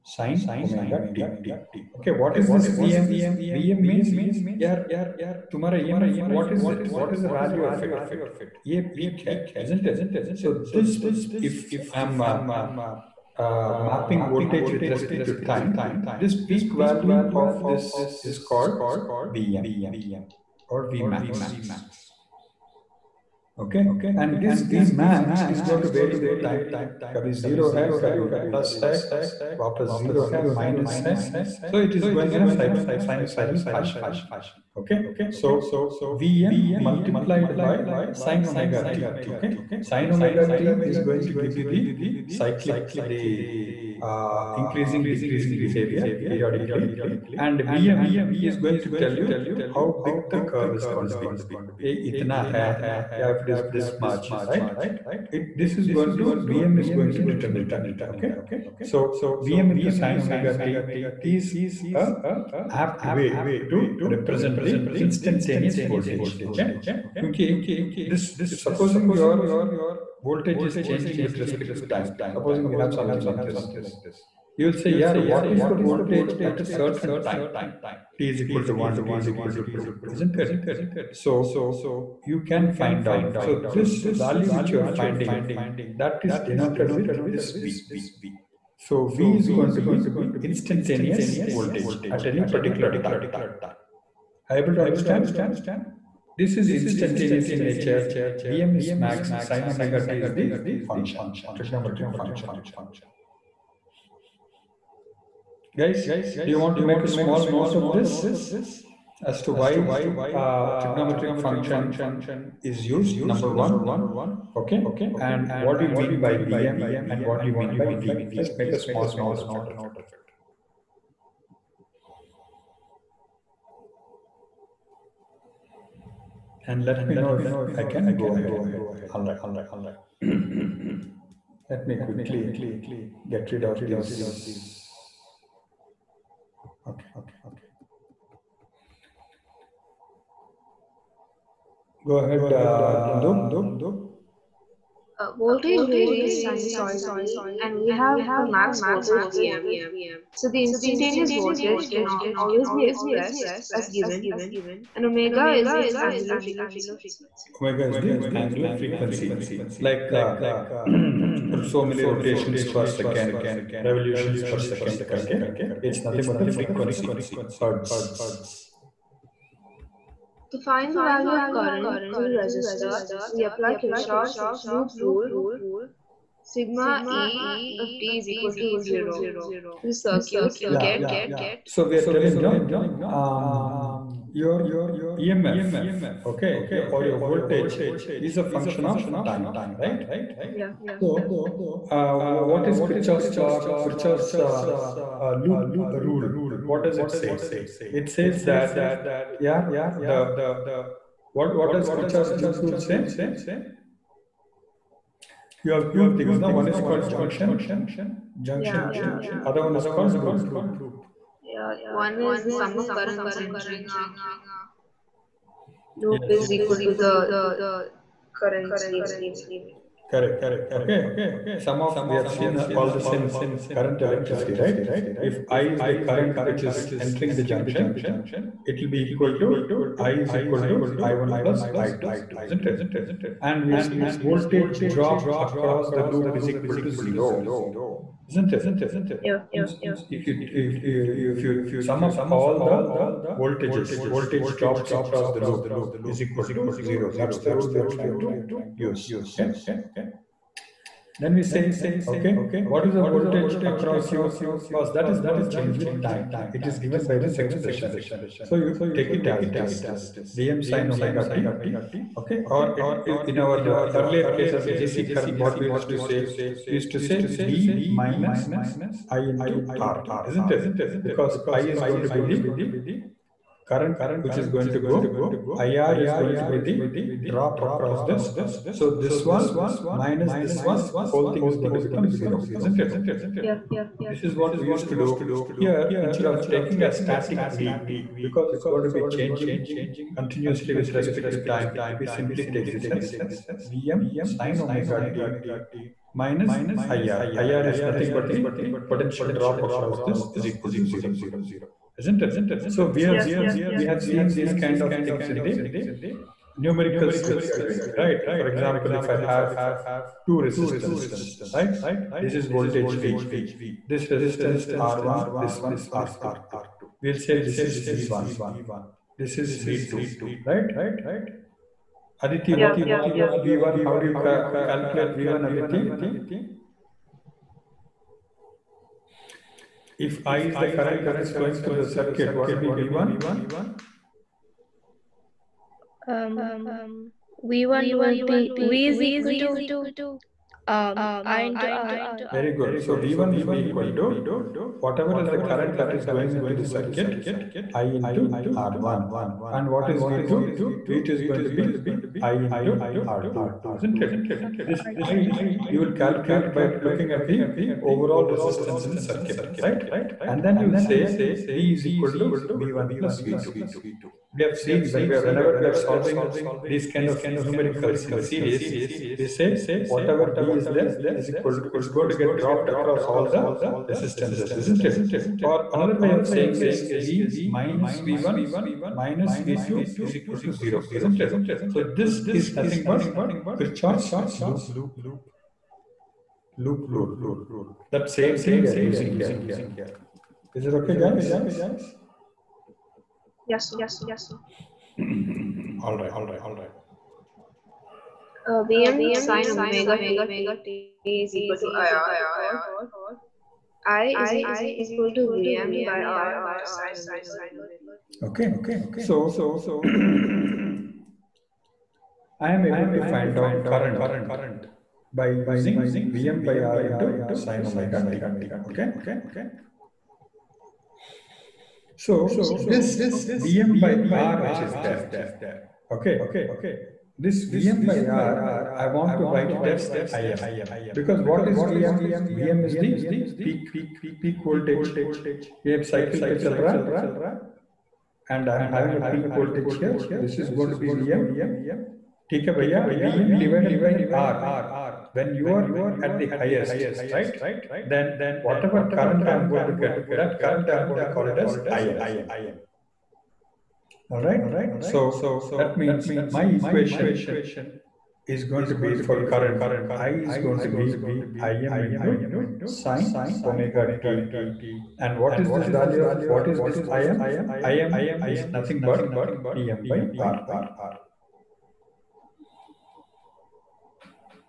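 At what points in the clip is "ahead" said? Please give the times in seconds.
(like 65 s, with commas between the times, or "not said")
128 s, 142 s.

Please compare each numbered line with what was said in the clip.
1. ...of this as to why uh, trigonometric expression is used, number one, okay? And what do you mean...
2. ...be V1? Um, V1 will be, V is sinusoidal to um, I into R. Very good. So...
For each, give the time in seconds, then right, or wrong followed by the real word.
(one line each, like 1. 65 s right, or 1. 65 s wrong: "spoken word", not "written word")
1. 107 s wrong: "function", not "expression"
2. 332 s wrong: "equal", not "sinusoidal".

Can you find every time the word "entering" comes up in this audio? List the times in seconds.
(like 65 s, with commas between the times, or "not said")
213 s, 226 s.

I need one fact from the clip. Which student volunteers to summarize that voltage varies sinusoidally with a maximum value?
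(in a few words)
Nandu.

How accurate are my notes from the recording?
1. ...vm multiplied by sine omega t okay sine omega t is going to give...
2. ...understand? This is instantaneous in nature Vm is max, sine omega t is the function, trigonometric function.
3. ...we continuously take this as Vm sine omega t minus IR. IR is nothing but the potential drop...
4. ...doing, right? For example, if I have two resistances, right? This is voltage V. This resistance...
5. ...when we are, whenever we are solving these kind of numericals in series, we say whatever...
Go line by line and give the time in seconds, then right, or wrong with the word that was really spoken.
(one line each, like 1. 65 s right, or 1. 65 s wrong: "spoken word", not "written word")
1. 36 s right
2. 94 s right
3. 291 s wrong: "simply", not "continuously"
4. 307 s right
5. 364 s right.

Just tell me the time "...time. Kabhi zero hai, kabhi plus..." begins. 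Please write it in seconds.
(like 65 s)
26 s.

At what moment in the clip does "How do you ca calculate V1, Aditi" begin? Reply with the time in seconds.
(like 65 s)
323 s.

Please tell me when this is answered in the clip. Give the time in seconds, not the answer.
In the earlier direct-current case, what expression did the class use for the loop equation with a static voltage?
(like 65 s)
267 s.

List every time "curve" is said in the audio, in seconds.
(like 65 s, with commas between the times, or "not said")
50 s.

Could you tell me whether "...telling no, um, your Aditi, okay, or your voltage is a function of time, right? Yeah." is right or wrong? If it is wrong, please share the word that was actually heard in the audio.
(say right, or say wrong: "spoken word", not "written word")
wrong: "EMF", not "Aditi".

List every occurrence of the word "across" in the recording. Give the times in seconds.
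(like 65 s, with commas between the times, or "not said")
235 s, 244 s, 253 s, 277 s, 299 s, 372 s.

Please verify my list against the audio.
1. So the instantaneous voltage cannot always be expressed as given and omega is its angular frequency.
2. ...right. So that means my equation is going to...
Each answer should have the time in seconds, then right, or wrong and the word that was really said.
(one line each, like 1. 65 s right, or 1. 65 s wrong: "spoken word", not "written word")
1. 150 s right
2. 454 s right.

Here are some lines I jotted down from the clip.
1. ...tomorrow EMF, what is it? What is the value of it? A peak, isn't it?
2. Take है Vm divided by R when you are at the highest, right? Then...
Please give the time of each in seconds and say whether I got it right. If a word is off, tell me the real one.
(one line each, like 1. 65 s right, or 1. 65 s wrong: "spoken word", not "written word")
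1. 5 s right
2. 442 s right.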